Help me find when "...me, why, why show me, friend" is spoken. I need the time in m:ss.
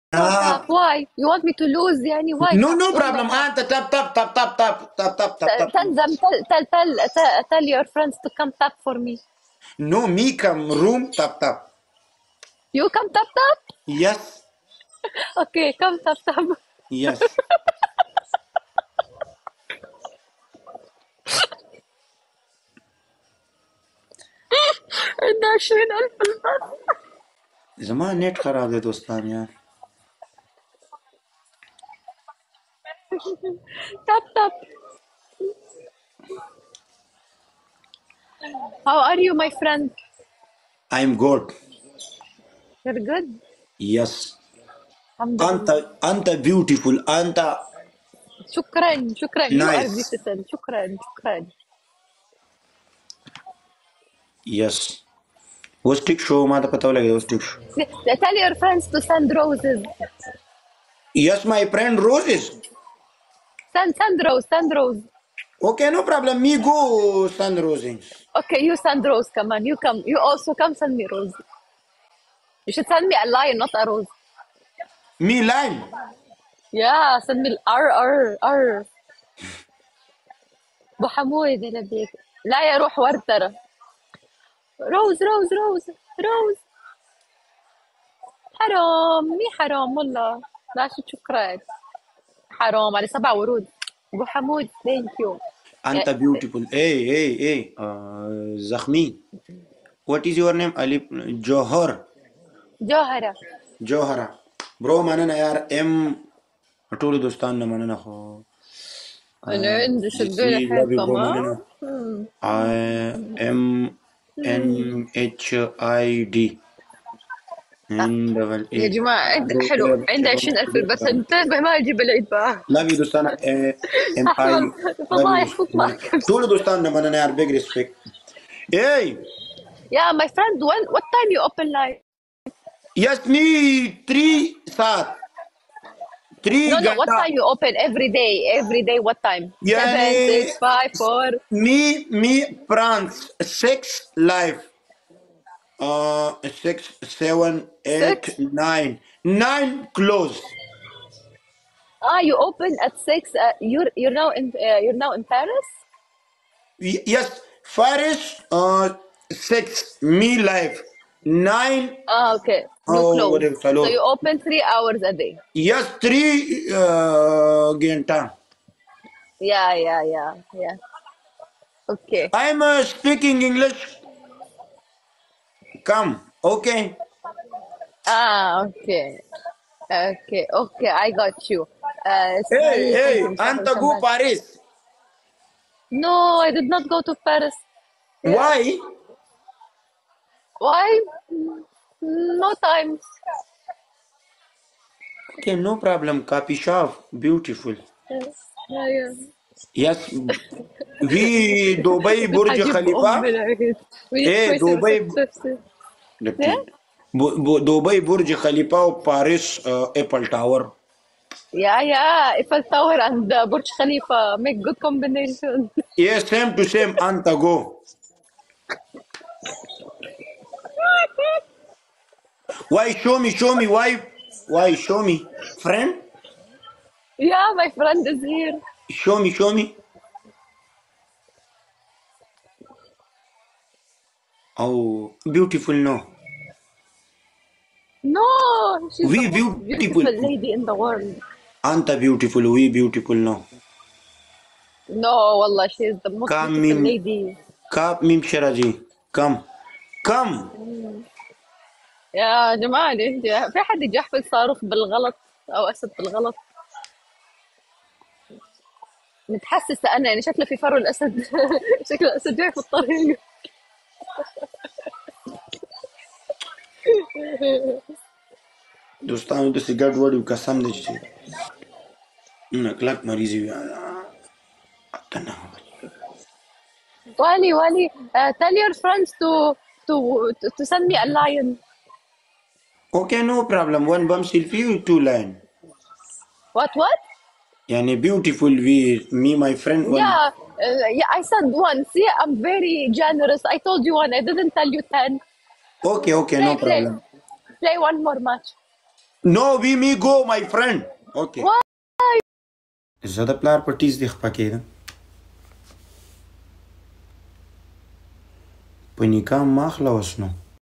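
3:43.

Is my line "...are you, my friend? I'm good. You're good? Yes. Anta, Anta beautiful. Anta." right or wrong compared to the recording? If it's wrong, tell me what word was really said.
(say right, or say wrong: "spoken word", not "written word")
right.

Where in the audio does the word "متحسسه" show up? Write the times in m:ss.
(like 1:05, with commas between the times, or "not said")
4:19.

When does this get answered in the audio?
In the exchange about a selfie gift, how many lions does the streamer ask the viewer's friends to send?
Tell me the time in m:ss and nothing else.
4:44.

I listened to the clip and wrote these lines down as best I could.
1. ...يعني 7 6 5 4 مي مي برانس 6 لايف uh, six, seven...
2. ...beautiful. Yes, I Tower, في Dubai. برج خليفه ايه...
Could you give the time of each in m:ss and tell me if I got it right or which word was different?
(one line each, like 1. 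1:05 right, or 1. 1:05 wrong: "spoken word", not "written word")
1. 2:19 right
2. 3:17 wrong: "Yes", not "Tower".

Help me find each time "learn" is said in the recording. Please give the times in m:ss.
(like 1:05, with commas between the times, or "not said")
not said.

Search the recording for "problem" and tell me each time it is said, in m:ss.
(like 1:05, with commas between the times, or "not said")
0:02, 3:15, 4:43, 4:56.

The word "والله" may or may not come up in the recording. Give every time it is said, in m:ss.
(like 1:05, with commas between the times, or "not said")
1:29, 4:05.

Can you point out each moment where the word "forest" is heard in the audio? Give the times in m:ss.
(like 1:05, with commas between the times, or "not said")
not said.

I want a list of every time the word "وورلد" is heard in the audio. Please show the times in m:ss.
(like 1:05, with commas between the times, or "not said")
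4:00.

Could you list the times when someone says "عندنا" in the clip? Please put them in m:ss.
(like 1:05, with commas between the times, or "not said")
0:25.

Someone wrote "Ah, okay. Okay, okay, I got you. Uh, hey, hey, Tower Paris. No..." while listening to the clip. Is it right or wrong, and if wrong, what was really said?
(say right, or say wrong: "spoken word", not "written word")
wrong: "Anta", not "Tower".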